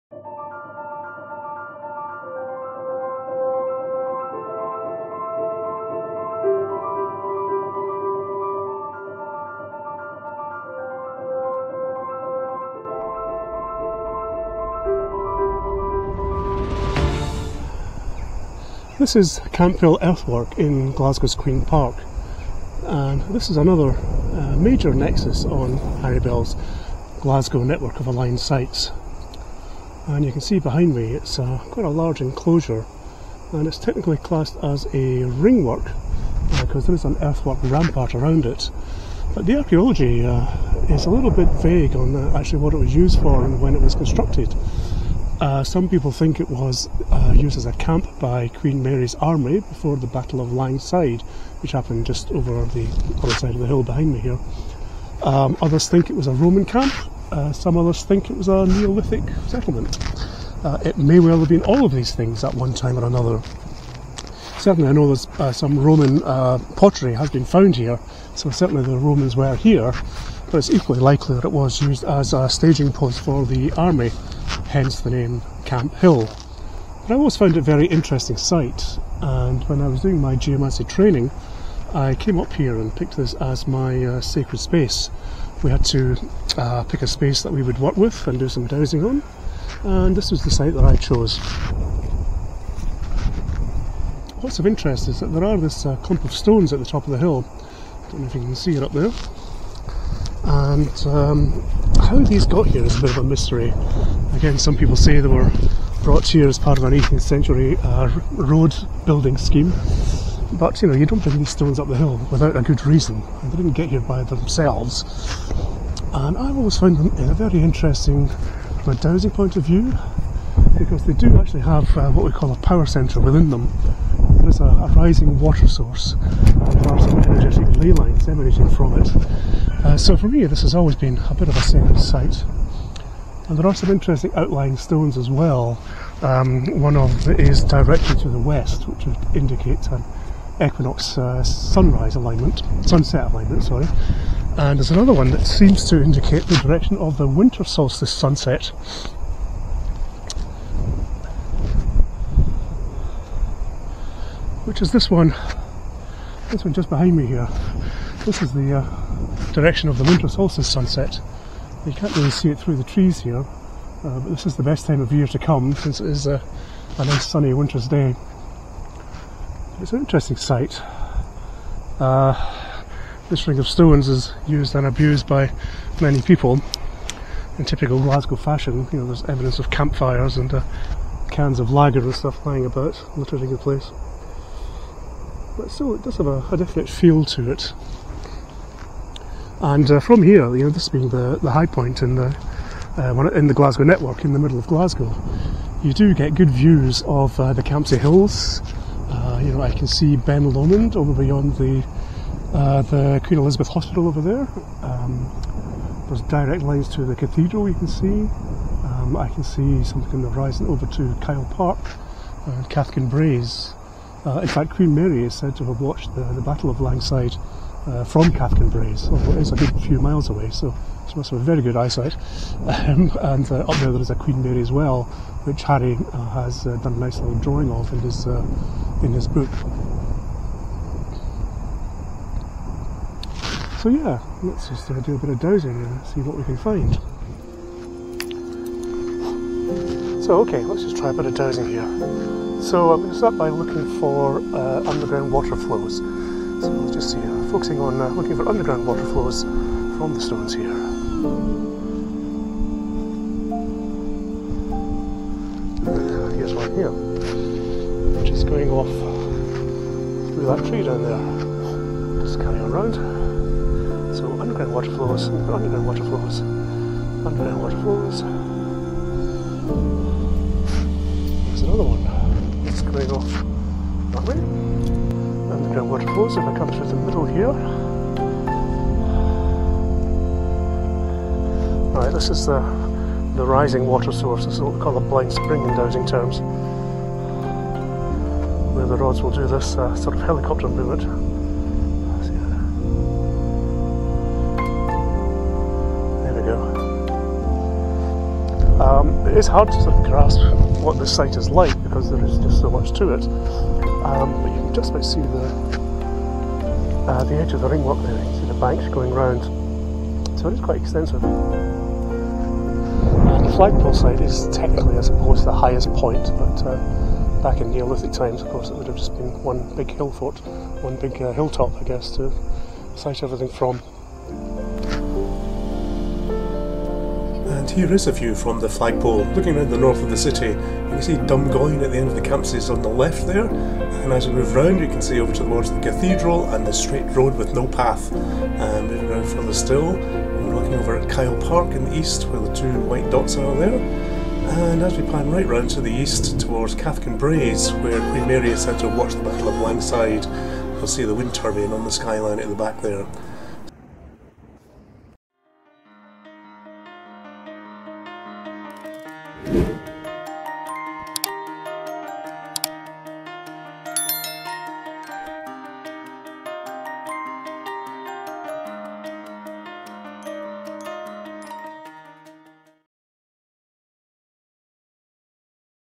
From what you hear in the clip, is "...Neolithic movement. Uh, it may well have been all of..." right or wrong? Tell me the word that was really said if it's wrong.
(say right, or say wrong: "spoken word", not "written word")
wrong: "settlement", not "movement".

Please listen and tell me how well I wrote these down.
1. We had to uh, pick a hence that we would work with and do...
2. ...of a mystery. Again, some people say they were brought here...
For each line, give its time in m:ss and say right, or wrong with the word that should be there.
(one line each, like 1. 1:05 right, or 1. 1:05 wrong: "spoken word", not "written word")
1. 1:25 wrong: "space", not "hence"
2. 1:43 right.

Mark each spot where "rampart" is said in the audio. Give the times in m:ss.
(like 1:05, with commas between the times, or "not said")
0:37.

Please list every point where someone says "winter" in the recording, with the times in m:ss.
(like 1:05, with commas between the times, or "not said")
2:27, 2:40, 2:47.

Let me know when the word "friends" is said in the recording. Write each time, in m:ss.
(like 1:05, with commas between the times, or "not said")
not said.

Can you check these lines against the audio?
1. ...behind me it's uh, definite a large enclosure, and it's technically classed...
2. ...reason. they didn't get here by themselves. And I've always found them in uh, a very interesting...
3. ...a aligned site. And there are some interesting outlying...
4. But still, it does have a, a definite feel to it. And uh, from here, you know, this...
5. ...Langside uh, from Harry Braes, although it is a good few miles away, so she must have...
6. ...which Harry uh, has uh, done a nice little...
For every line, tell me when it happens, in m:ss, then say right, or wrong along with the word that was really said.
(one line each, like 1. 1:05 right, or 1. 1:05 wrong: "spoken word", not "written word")
1. 0:30 wrong: "quite", not "definite"
2. 1:52 right
3. 2:11 wrong: "sacred", not "aligned"
4. 3:05 right
5. 3:36 wrong: "Cathkin", not "Harry"
6. 3:45 right.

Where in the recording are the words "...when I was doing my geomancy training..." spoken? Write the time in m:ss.
1:19.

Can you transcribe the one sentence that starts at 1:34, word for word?
What's of interest is that there are this uh, clump of stones at the top of the hill.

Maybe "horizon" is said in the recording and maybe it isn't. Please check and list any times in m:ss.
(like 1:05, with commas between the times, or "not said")
3:30.